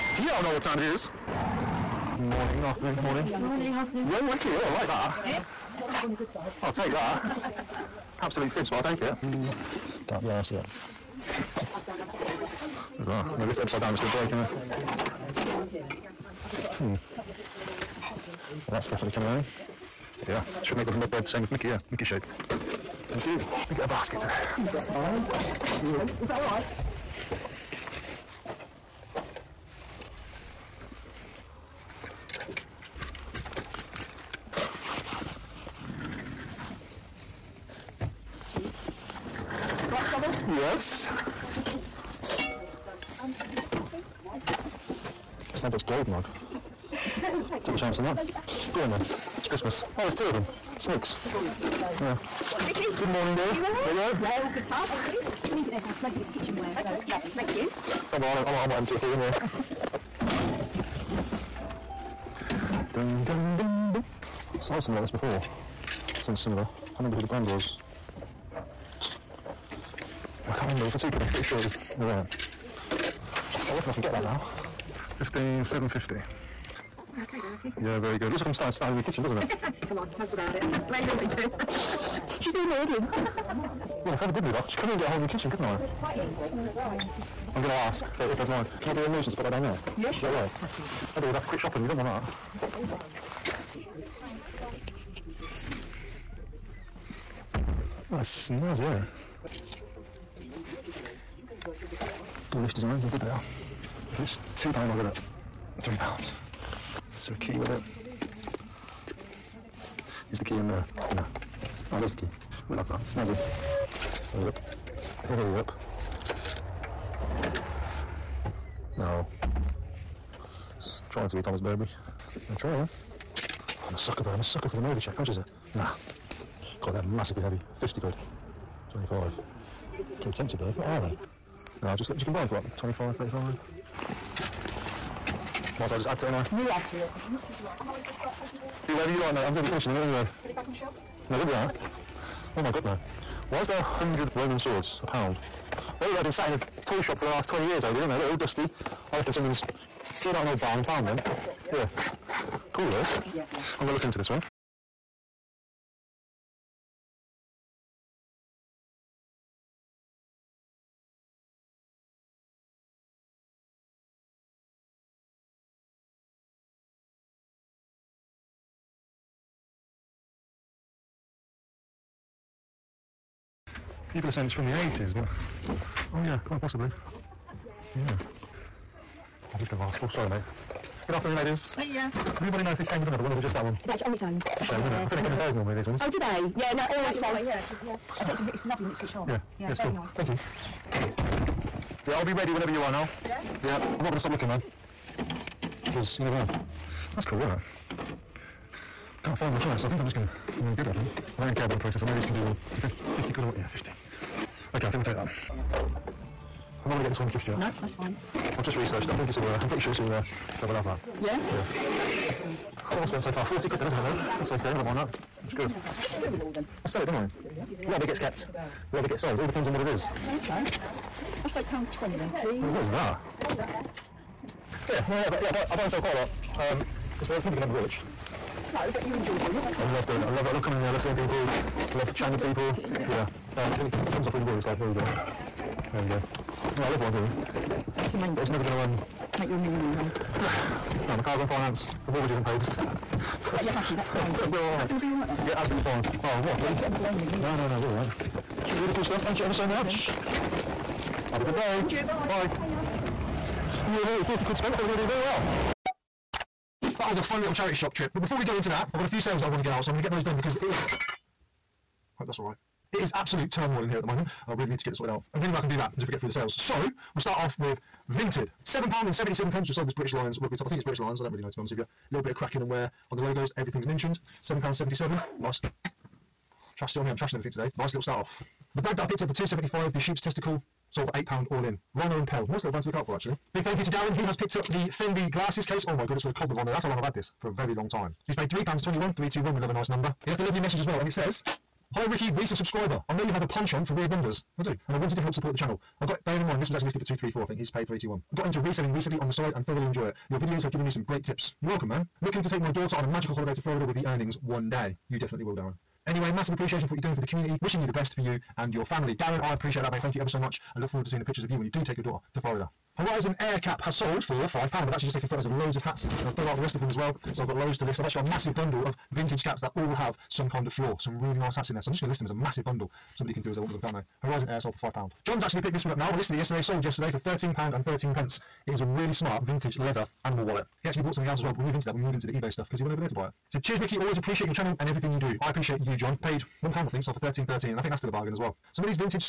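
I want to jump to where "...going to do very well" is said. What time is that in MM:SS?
04:14.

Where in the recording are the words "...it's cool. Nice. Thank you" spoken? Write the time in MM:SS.
03:09.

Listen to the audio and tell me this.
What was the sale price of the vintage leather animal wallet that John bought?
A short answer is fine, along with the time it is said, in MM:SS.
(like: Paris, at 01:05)
£13.13, at 05:27.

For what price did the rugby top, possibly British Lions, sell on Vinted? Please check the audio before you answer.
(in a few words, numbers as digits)
£7.77.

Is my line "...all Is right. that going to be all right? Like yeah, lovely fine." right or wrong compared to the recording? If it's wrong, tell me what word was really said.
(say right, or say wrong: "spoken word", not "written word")
wrong: "absolutely", not "lovely".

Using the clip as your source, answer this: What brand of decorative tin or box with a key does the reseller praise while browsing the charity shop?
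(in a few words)
Dulwich Designs.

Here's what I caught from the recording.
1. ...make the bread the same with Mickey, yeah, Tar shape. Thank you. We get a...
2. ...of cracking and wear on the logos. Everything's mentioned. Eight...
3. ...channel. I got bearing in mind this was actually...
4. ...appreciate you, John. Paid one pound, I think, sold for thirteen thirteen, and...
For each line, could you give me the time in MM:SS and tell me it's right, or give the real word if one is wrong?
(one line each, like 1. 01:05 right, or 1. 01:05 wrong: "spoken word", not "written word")
1. 00:20 wrong: "Mickey", not "Tar"
2. 04:32 wrong: "Seven", not "Eight"
3. 04:55 right
4. 05:35 right.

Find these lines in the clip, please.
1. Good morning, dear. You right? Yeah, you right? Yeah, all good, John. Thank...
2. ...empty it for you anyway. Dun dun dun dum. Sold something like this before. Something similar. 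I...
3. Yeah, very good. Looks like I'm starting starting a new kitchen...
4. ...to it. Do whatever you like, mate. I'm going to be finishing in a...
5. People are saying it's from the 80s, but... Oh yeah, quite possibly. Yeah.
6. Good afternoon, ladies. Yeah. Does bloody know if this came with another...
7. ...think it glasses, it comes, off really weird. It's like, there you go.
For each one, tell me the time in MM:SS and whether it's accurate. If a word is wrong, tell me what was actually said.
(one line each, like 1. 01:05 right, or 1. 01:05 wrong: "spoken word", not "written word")
1. 00:52 wrong: "Tar", not "John"
2. 00:58 right
3. 01:17 right
4. 02:16 right
5. 02:54 right
6. 03:01 wrong: "anybody", not "bloody"
7. 03:53 wrong: "comes", not "glasses".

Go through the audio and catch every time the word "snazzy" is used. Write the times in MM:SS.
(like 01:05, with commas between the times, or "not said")
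01:38, 01:53.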